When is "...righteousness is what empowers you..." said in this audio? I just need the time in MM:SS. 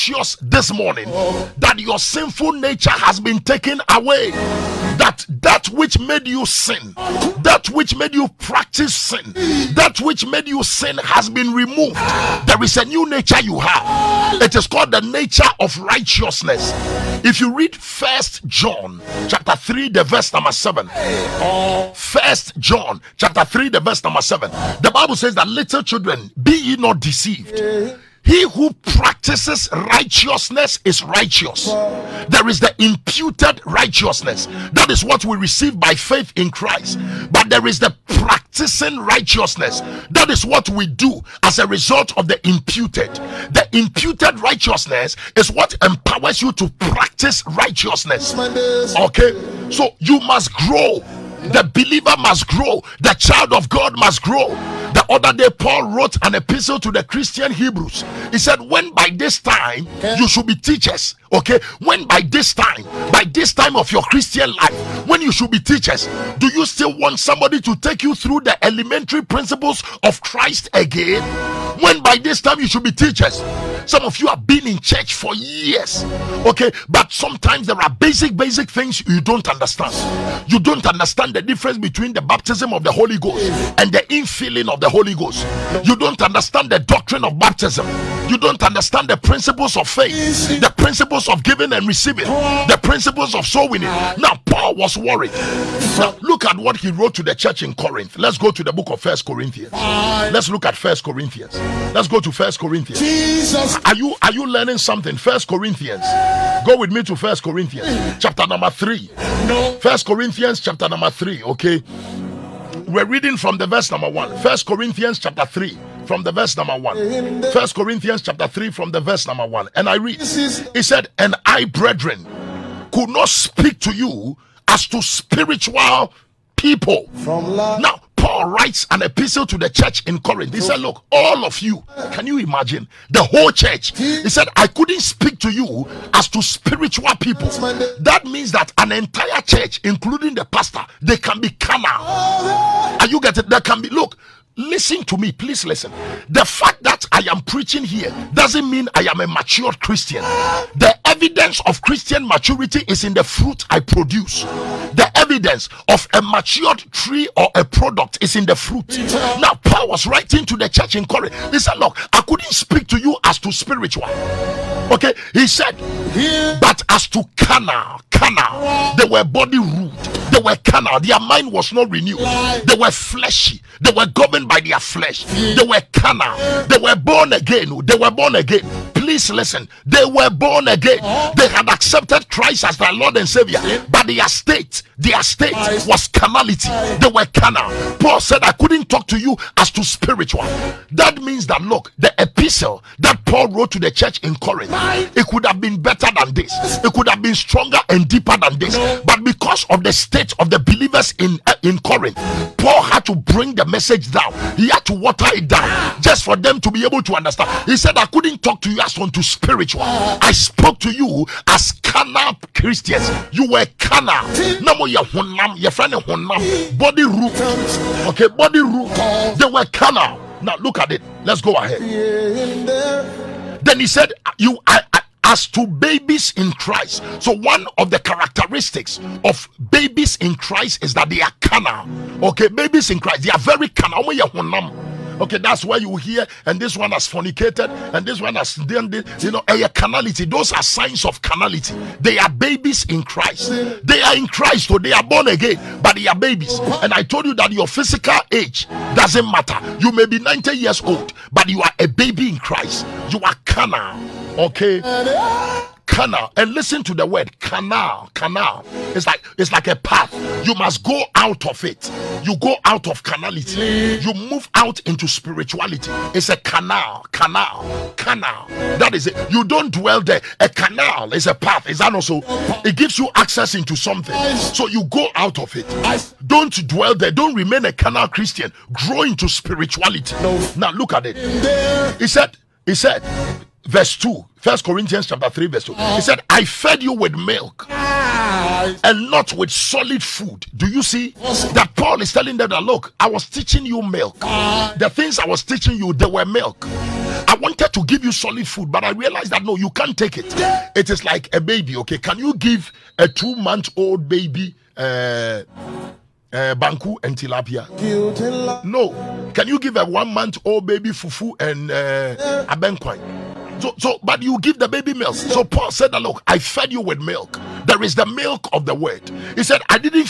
00:44.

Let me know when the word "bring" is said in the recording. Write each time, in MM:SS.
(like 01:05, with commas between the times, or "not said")
03:23.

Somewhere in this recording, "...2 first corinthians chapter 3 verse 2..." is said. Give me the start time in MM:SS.
04:43.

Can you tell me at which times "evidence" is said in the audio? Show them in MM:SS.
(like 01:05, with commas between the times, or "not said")
02:31, 02:35.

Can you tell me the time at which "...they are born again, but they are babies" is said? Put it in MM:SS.
04:04.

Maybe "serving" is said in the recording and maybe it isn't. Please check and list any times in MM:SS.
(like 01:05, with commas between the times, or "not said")
not said.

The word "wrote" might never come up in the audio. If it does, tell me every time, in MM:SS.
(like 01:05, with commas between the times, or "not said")
00:55, 01:36, 03:13.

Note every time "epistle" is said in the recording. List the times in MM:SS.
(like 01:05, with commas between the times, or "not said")
00:56, 02:09, 03:12.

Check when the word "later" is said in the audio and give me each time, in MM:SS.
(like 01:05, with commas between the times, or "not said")
not said.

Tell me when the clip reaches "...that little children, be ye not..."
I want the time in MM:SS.
00:25.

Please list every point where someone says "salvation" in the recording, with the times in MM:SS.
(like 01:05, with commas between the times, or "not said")
not said.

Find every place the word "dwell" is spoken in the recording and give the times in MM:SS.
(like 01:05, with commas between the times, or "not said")
04:29, 04:36.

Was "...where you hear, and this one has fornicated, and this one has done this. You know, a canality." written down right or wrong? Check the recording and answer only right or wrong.
wrong.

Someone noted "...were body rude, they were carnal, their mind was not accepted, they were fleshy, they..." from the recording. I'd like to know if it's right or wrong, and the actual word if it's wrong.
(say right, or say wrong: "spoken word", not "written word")
wrong: "renewed", not "accepted".